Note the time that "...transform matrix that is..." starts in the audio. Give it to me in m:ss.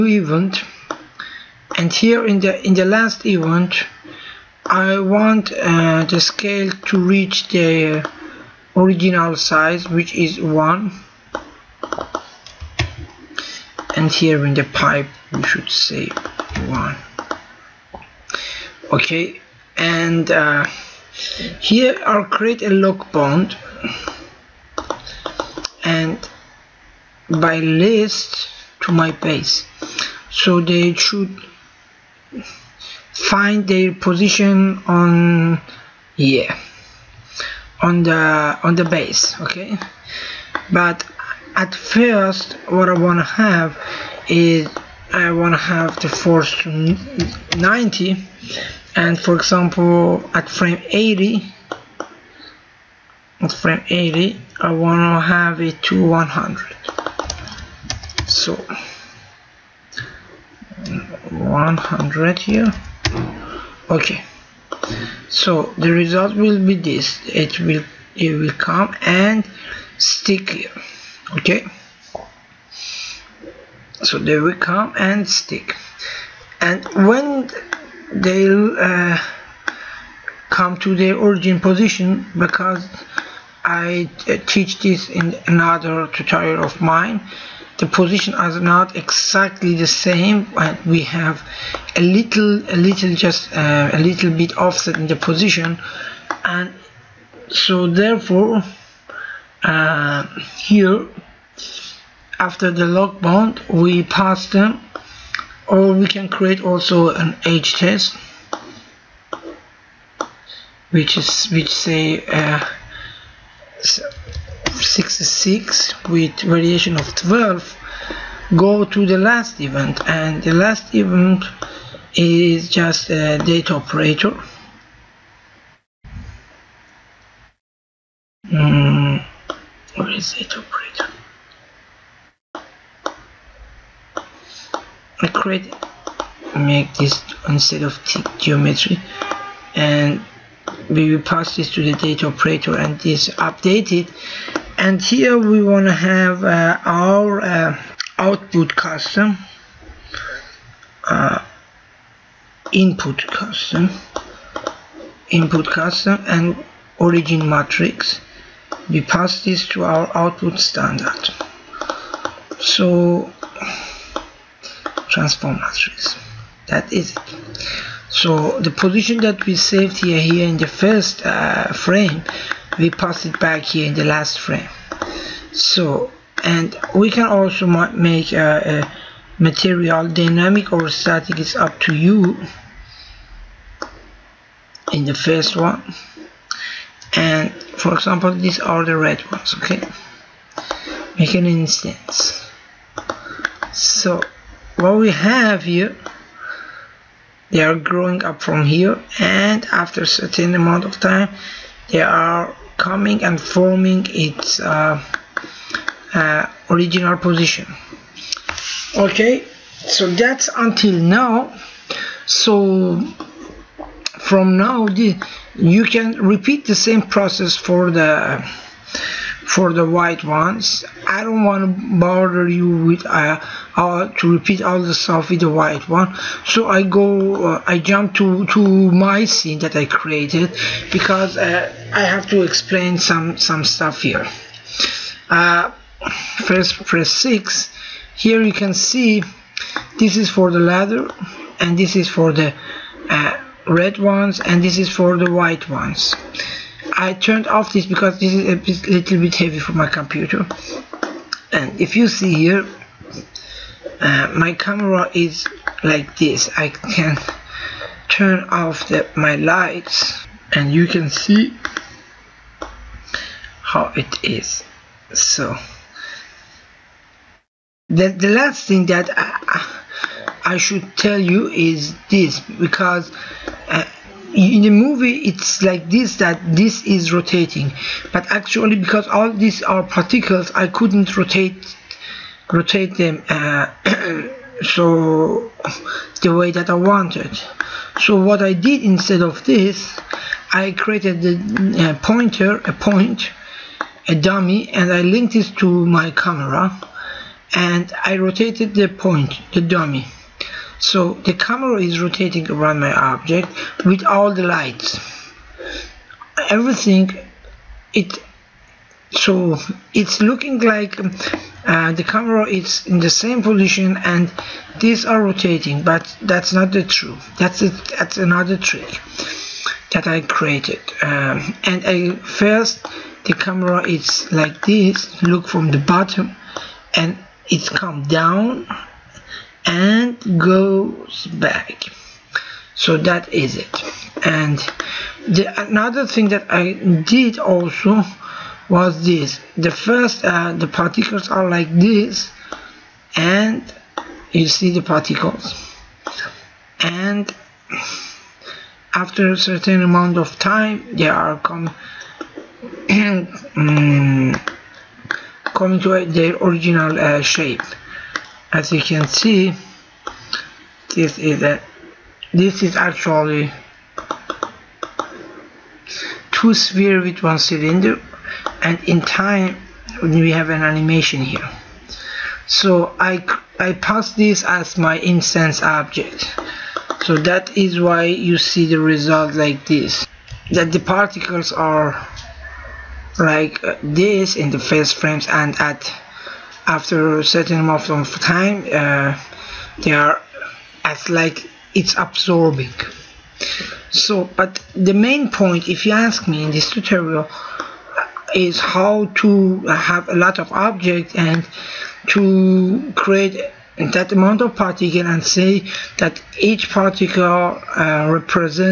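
2:45.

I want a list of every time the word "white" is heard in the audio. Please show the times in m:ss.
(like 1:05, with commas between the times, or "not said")
3:39, 3:45, 4:05.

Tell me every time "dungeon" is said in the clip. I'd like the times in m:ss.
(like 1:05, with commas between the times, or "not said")
not said.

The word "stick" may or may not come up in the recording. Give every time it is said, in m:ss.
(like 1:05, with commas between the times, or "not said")
1:09, 1:15.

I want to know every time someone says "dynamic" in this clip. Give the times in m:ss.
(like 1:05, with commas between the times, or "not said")
3:00.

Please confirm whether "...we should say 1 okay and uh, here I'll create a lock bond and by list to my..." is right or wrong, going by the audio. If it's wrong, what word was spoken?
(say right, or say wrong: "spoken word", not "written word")
right.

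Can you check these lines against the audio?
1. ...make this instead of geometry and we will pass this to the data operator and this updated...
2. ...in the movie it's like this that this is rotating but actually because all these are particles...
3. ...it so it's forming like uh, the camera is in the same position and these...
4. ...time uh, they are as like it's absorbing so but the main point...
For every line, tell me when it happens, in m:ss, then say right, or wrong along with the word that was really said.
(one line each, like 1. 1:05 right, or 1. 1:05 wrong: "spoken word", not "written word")
1. 2:16 right
2. 4:34 right
3. 5:07 wrong: "looking", not "forming"
4. 6:28 right.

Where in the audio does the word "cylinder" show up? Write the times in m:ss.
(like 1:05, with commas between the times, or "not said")
6:07.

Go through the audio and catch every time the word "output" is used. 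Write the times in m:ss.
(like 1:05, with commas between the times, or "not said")
2:28, 2:40.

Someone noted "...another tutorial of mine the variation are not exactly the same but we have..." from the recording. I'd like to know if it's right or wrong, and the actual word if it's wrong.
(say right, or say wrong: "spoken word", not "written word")
wrong: "position", not "variation".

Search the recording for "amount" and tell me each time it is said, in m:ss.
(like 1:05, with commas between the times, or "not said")
3:20, 5:49, 6:27, 6:44.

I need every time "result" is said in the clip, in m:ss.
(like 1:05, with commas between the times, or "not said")
1:05, 6:18.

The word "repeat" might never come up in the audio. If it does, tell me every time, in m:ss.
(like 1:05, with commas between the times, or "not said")
3:36, 3:44.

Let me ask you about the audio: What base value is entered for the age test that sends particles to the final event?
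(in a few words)
66.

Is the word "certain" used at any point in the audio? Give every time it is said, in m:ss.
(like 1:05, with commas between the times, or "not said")
3:20, 5:49, 6:27.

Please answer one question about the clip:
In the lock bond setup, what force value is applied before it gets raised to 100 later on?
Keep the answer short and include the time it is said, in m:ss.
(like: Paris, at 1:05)
90, at 0:47.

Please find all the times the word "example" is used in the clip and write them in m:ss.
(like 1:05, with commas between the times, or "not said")
0:49, 3:07.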